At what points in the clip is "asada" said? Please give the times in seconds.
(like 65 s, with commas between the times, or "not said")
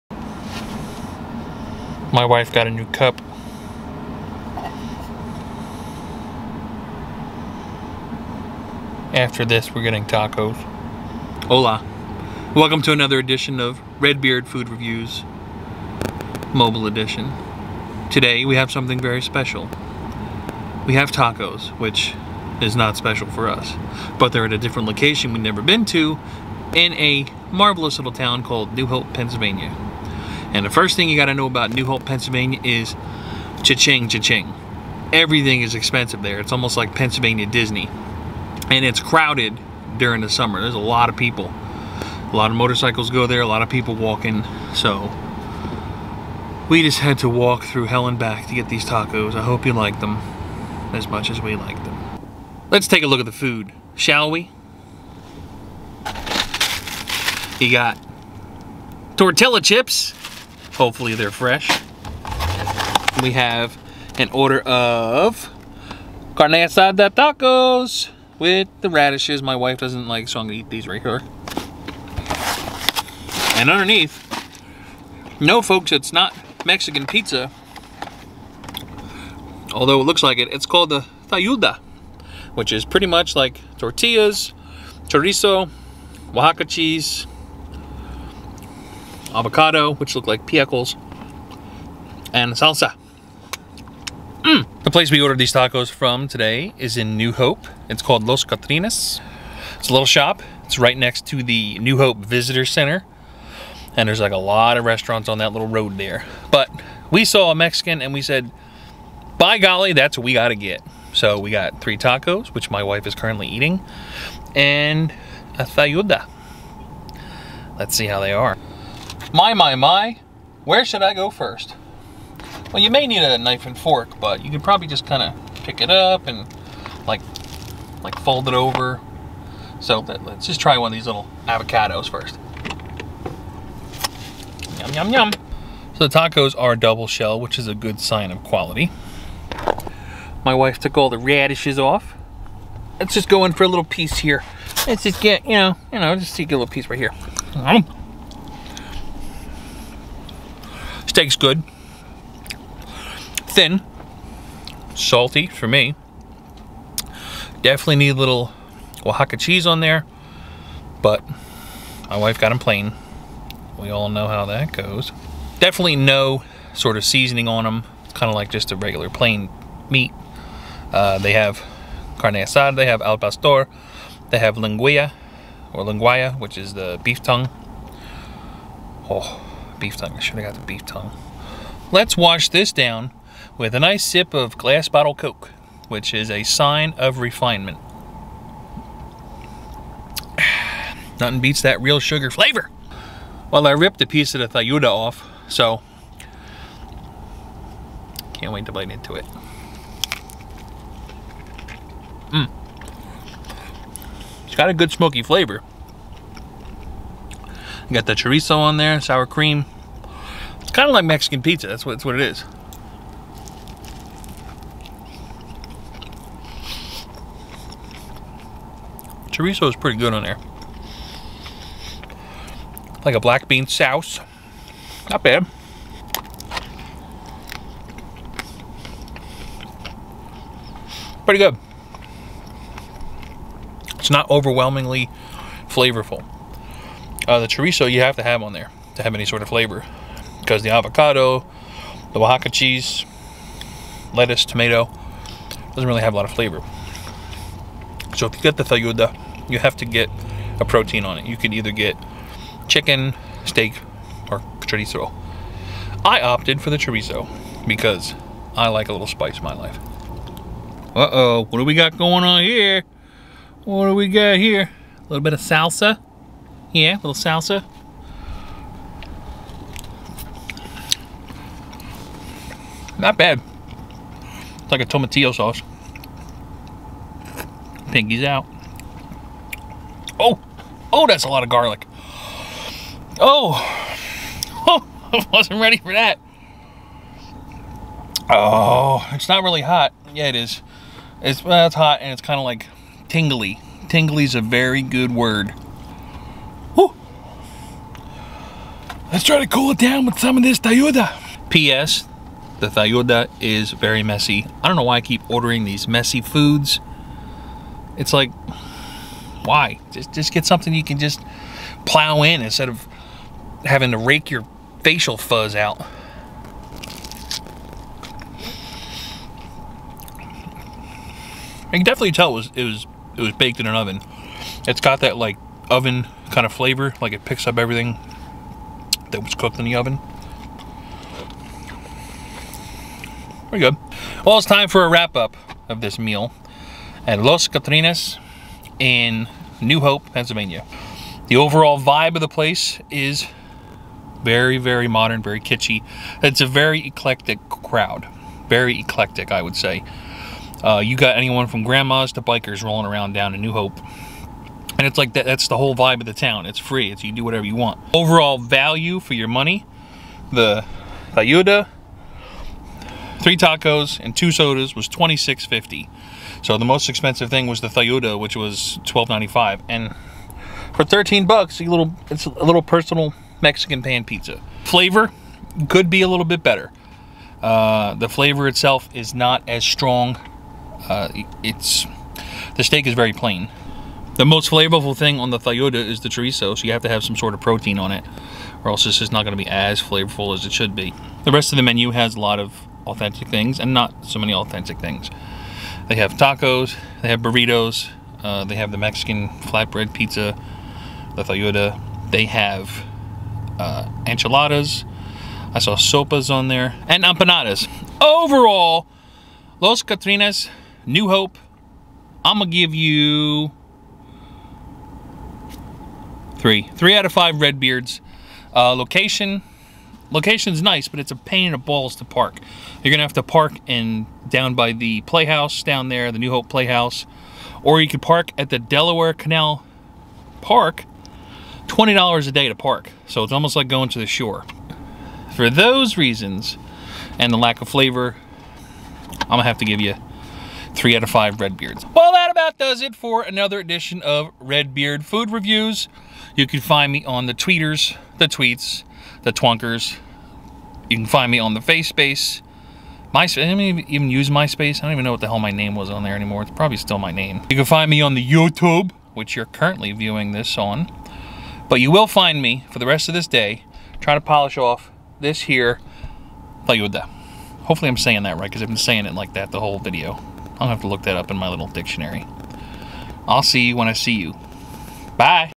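66 s, 172 s.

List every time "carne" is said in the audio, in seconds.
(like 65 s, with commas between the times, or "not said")
66 s, 172 s.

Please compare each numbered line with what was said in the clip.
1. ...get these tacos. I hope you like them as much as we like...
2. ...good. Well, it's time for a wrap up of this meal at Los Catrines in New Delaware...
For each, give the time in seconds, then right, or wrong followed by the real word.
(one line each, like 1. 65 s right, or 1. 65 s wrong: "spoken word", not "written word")
1. 48 s right
2. 333 s wrong: "Hope", not "Delaware".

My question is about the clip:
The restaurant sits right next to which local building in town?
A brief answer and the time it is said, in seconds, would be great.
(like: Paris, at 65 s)
New Hope Visitor Center, at 101 s.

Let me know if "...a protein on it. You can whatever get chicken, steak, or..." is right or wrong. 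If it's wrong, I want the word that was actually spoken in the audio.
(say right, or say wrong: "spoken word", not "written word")
wrong: "either", not "whatever".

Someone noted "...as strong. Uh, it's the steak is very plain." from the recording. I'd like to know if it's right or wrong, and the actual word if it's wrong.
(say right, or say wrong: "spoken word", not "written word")
right.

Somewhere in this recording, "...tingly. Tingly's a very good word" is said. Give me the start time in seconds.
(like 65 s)
293 s.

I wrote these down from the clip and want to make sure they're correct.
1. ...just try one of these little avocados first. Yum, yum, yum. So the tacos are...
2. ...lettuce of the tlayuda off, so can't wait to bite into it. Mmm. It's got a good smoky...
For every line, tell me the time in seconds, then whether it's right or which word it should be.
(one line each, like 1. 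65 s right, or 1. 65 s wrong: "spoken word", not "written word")
1. 130 s right
2. 194 s wrong: "piece", not "lettuce".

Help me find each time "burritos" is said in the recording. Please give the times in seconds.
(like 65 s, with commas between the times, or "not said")
397 s.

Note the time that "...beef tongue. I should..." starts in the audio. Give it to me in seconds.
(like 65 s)
179 s.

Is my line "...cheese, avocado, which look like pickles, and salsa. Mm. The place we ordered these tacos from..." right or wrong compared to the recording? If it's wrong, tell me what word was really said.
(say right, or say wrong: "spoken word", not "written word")
right.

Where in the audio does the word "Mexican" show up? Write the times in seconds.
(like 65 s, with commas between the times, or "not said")
76 s, 107 s, 211 s, 373 s, 398 s.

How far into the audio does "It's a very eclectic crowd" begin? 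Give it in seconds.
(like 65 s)
346 s.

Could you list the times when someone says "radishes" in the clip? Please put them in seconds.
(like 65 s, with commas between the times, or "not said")
68 s, 141 s.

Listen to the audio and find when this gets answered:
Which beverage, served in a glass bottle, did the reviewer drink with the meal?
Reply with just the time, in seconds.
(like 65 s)
185 s.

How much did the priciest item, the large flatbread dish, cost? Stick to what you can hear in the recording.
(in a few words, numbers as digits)
$12.95.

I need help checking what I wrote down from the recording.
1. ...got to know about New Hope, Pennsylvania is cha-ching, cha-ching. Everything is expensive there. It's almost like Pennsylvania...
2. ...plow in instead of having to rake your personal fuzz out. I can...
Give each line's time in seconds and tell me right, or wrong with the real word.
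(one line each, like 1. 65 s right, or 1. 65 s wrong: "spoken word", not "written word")
1. 31 s right
2. 311 s wrong: "facial", not "personal".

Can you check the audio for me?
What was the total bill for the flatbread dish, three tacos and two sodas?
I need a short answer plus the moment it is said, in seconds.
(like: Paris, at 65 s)
$26.50, at 364 s.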